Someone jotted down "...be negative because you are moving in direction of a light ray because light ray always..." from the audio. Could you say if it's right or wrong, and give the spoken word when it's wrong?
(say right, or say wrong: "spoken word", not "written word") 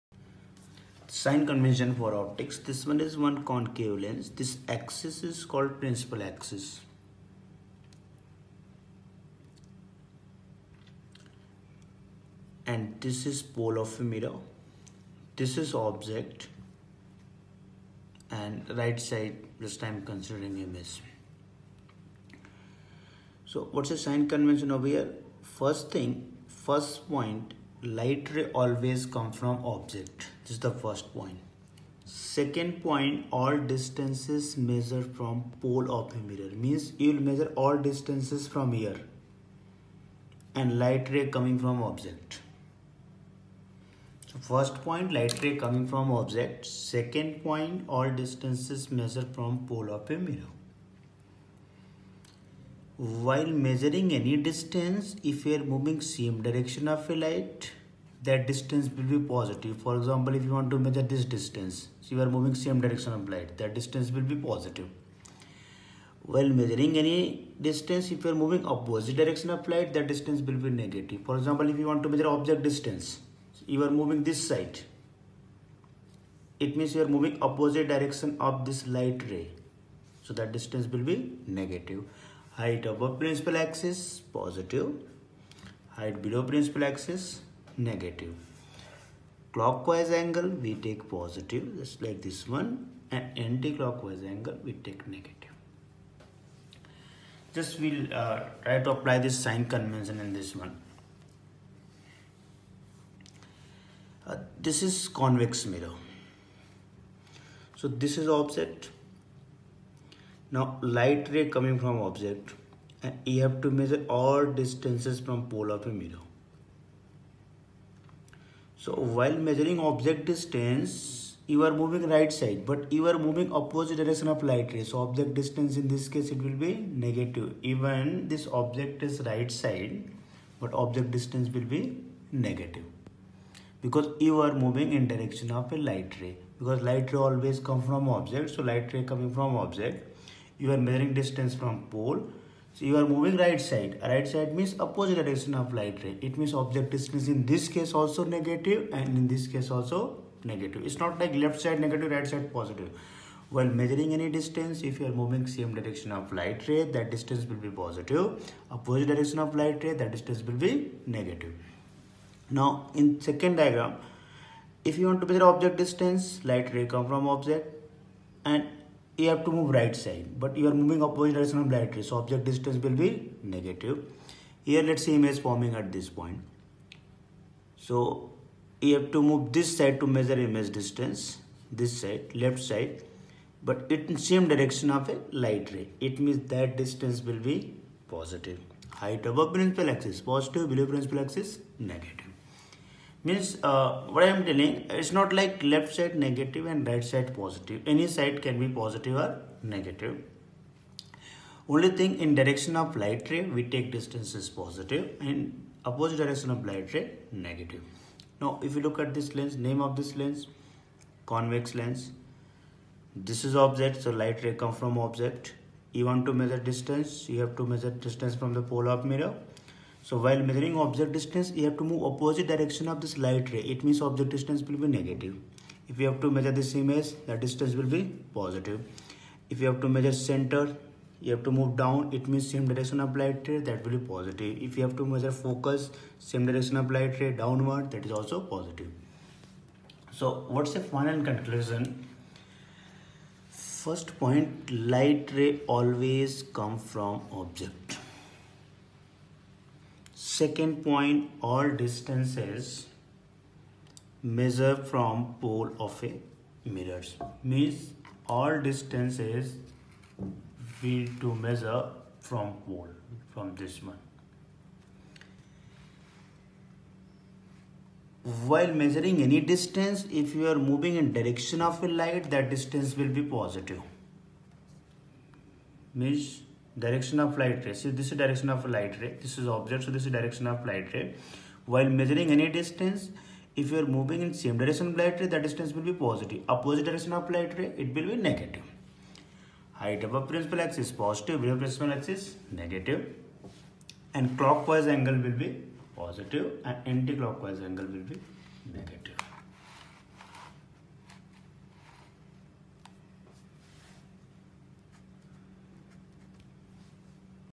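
right.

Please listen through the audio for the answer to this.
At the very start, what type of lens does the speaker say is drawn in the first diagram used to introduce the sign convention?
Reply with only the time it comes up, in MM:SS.
00:03.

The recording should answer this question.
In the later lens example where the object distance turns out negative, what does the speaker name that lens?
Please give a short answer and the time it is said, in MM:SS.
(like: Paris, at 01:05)
convex lens, at 03:31.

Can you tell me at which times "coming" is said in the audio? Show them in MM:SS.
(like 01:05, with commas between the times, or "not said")
00:41, 00:45, 01:51, 02:19.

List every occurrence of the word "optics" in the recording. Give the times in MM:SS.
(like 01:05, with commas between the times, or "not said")
00:02.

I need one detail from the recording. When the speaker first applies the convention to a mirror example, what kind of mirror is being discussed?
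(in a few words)
convex mirror.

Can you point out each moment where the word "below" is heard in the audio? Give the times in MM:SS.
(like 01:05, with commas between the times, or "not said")
01:26, 03:10.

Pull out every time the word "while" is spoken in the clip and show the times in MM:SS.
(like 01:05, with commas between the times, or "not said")
00:53, 01:06, 01:59, 02:33, 03:40, 04:28, 04:41.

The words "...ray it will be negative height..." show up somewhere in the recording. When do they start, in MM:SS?
04:47.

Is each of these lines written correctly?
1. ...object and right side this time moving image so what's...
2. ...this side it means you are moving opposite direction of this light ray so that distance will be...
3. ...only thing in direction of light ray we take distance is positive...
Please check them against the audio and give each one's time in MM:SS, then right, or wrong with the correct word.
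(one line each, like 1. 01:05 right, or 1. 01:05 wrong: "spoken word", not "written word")
1. 00:15 wrong: "considering", not "moving"
2. 01:14 right
3. 03:21 right.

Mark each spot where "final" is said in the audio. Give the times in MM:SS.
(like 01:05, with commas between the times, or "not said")
04:00.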